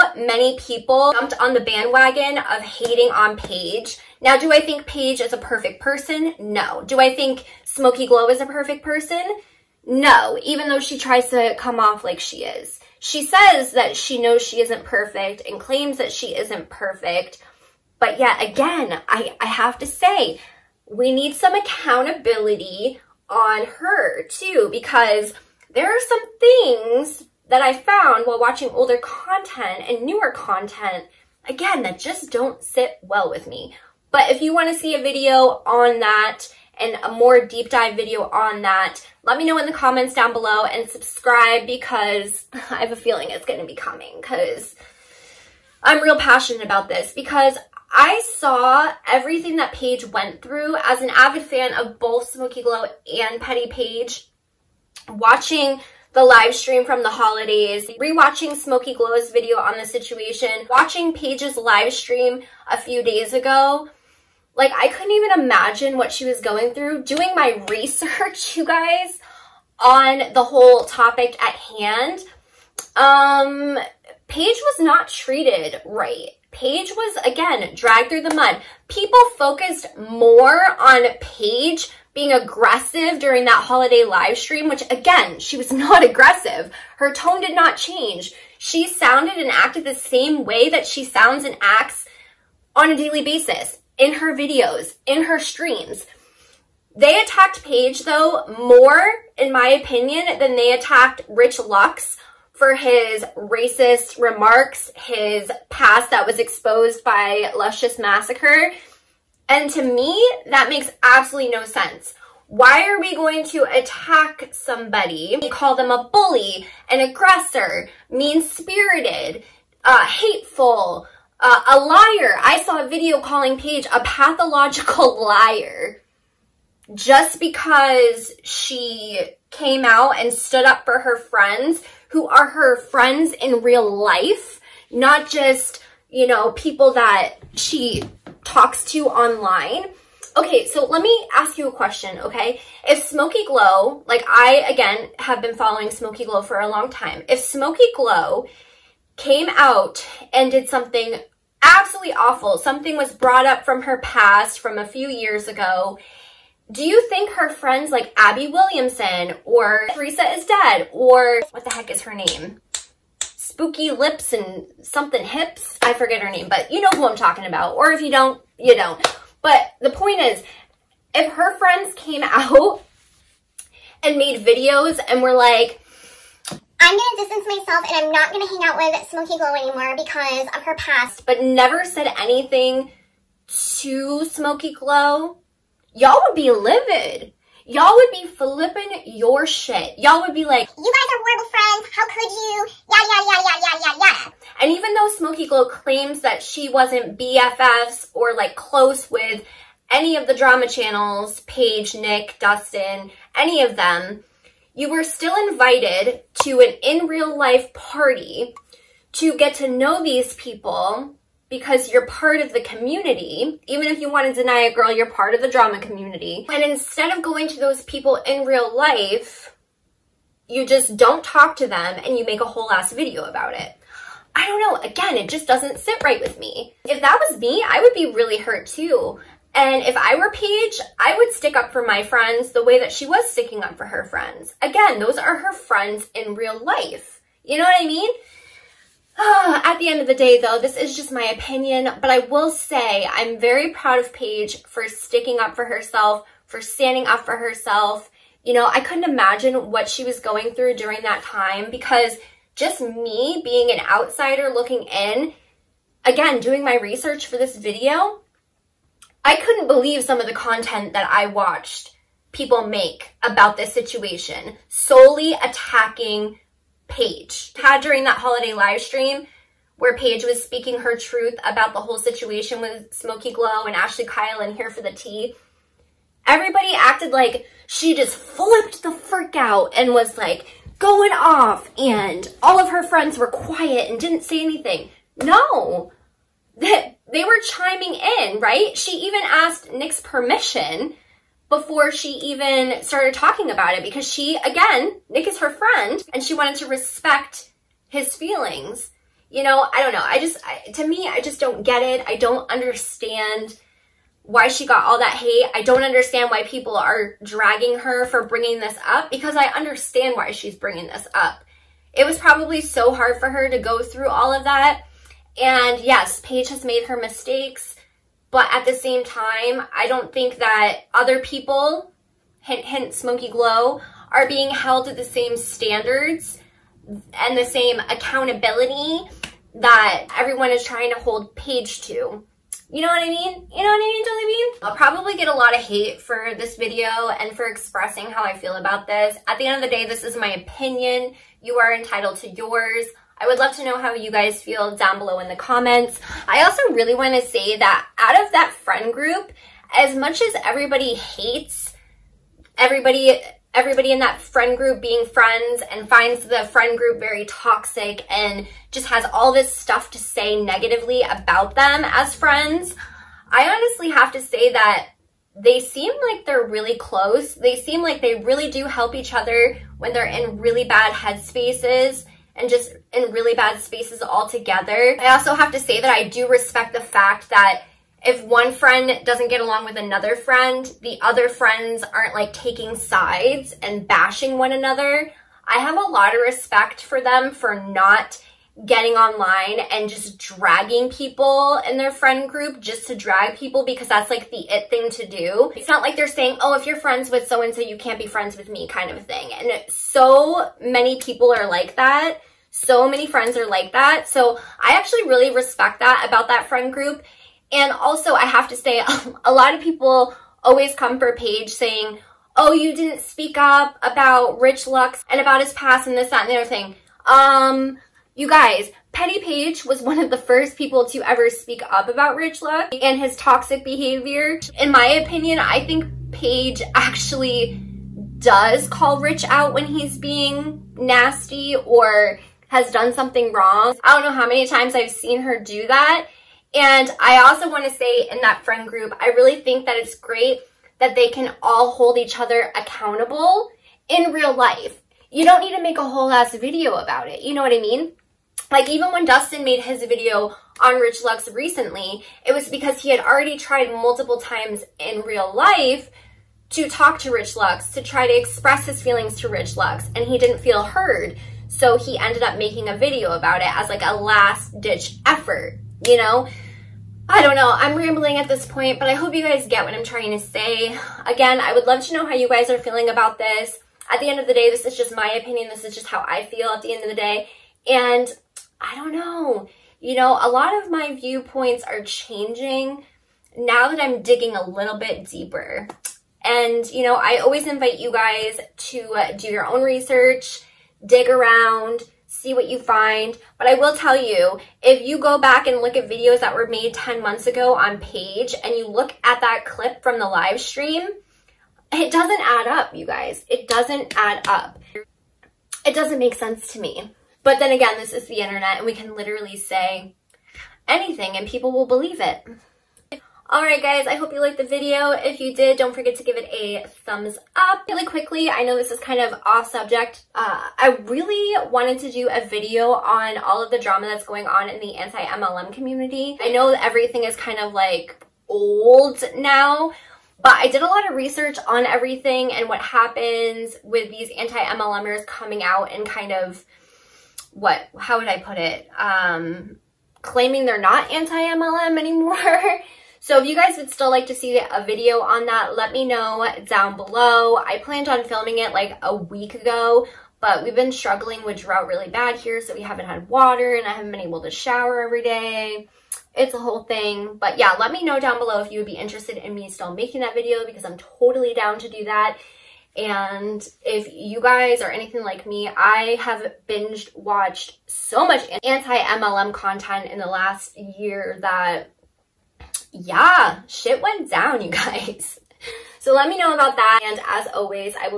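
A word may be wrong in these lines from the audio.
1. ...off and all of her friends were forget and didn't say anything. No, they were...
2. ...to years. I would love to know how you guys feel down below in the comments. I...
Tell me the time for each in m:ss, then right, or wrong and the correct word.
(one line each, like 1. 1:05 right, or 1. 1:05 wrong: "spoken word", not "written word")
1. 4:41 wrong: "quiet", not "forget"
2. 5:42 wrong: "yours", not "years".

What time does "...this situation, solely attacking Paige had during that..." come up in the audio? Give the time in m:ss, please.
4:23.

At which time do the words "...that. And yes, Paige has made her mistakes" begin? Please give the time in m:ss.
5:14.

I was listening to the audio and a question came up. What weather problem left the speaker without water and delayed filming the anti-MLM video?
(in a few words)
drought.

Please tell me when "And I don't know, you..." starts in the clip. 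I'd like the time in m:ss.
7:57.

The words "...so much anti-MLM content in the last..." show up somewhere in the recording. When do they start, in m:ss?
9:27.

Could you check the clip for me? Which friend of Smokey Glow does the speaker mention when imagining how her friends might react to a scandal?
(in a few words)
Abby Williamson.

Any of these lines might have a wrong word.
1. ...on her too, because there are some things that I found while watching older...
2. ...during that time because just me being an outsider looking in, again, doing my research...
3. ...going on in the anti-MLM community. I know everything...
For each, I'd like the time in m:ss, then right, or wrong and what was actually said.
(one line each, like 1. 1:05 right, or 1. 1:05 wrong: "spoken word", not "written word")
1. 0:23 right
2. 4:10 right
3. 8:44 right.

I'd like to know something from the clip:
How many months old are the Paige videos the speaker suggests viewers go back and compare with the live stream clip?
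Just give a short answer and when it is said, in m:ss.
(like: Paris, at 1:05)
10, at 8:16.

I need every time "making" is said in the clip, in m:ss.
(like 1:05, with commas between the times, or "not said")
7:42, 9:19.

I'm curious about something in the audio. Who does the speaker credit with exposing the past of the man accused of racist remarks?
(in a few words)
Luscious Massacre.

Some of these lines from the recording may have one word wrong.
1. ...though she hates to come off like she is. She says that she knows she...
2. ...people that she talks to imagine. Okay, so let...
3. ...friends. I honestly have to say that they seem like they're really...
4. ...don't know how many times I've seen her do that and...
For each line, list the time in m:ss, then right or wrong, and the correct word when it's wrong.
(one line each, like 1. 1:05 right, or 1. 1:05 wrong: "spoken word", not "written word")
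1. 0:10 wrong: "tries", not "hates"
2. 2:16 wrong: "online", not "imagine"
3. 6:02 right
4. 7:13 right.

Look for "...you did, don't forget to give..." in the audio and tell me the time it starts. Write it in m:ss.
8:35.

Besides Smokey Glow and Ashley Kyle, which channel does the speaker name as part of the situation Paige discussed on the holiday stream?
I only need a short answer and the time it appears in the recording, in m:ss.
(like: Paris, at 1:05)
Here for the Tea, at 4:34.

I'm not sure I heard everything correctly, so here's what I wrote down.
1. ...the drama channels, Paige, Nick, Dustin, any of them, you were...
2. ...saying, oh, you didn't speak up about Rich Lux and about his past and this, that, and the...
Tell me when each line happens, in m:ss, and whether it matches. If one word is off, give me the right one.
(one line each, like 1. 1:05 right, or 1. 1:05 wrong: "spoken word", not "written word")
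1. 3:20 right
2. 6:51 right.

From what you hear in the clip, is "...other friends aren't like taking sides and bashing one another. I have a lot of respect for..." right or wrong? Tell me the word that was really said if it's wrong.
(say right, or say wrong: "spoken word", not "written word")
right.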